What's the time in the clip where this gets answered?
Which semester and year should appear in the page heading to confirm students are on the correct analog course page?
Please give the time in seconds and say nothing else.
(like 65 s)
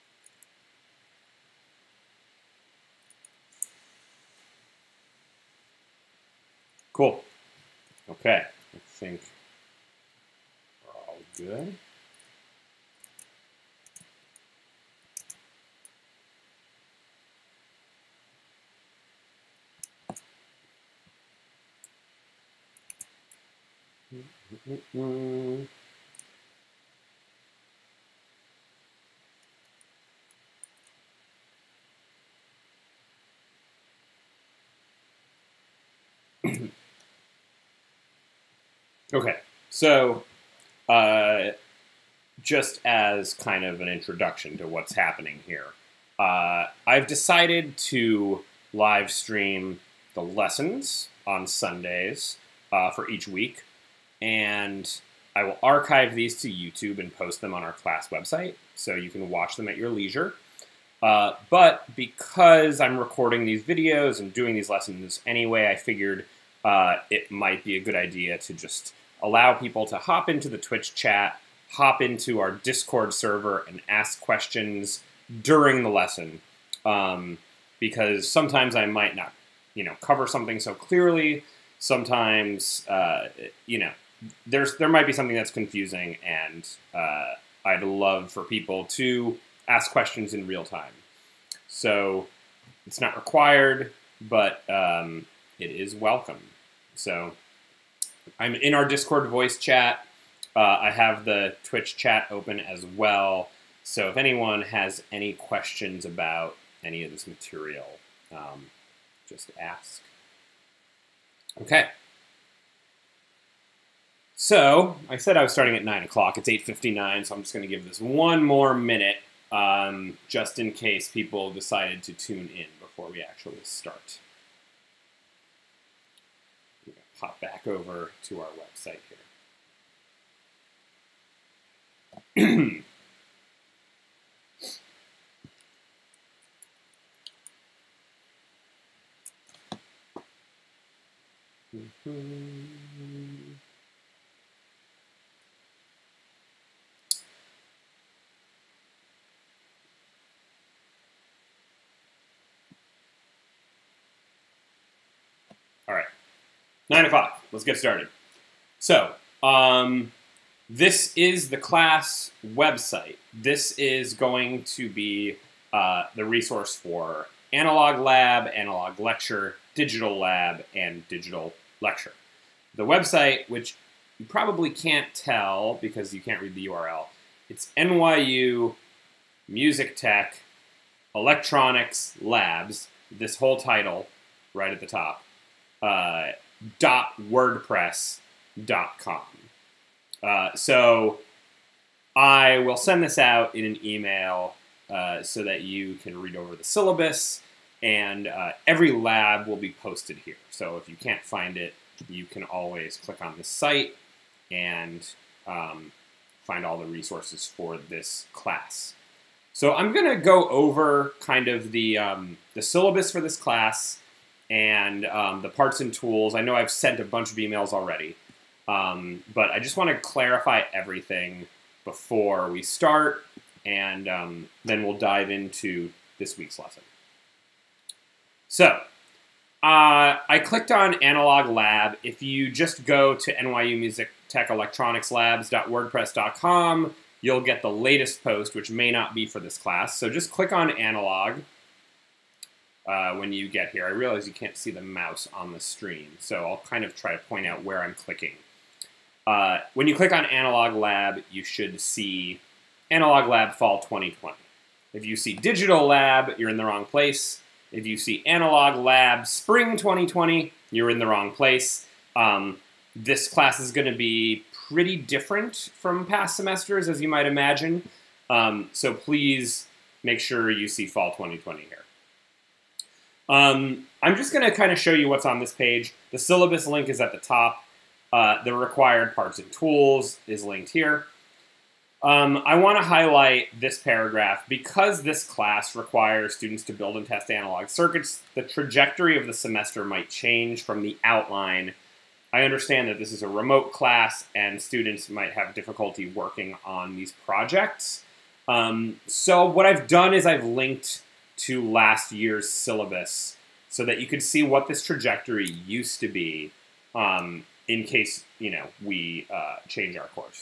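252 s.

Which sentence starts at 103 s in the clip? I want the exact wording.
So if anyone has any questions about any of this material, um, just ask.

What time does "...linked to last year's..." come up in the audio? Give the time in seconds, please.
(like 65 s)
300 s.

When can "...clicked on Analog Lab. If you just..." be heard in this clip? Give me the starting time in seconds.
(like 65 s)
230 s.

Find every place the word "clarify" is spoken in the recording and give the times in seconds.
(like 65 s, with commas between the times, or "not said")
219 s.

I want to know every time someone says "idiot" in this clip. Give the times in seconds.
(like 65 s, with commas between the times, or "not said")
not said.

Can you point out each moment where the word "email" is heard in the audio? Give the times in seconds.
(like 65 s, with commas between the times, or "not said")
193 s, 217 s.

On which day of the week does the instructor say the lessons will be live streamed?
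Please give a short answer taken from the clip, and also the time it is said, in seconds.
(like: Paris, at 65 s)
Sundays, at 51 s.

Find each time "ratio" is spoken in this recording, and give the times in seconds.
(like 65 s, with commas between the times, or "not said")
not said.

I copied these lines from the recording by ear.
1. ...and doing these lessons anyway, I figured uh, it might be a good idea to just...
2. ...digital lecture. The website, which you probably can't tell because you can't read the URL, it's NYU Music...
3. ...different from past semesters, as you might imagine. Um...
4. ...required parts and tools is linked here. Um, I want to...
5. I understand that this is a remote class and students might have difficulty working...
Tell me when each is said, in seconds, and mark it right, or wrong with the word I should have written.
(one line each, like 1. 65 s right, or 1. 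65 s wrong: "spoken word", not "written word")
1. 64 s right
2. 171 s right
3. 264 s right
4. 278 s right
5. 292 s right.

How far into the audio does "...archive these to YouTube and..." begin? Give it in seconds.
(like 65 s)
55 s.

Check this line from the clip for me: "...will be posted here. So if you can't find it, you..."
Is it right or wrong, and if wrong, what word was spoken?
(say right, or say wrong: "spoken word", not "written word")
right.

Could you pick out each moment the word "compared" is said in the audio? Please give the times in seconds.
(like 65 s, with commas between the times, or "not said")
not said.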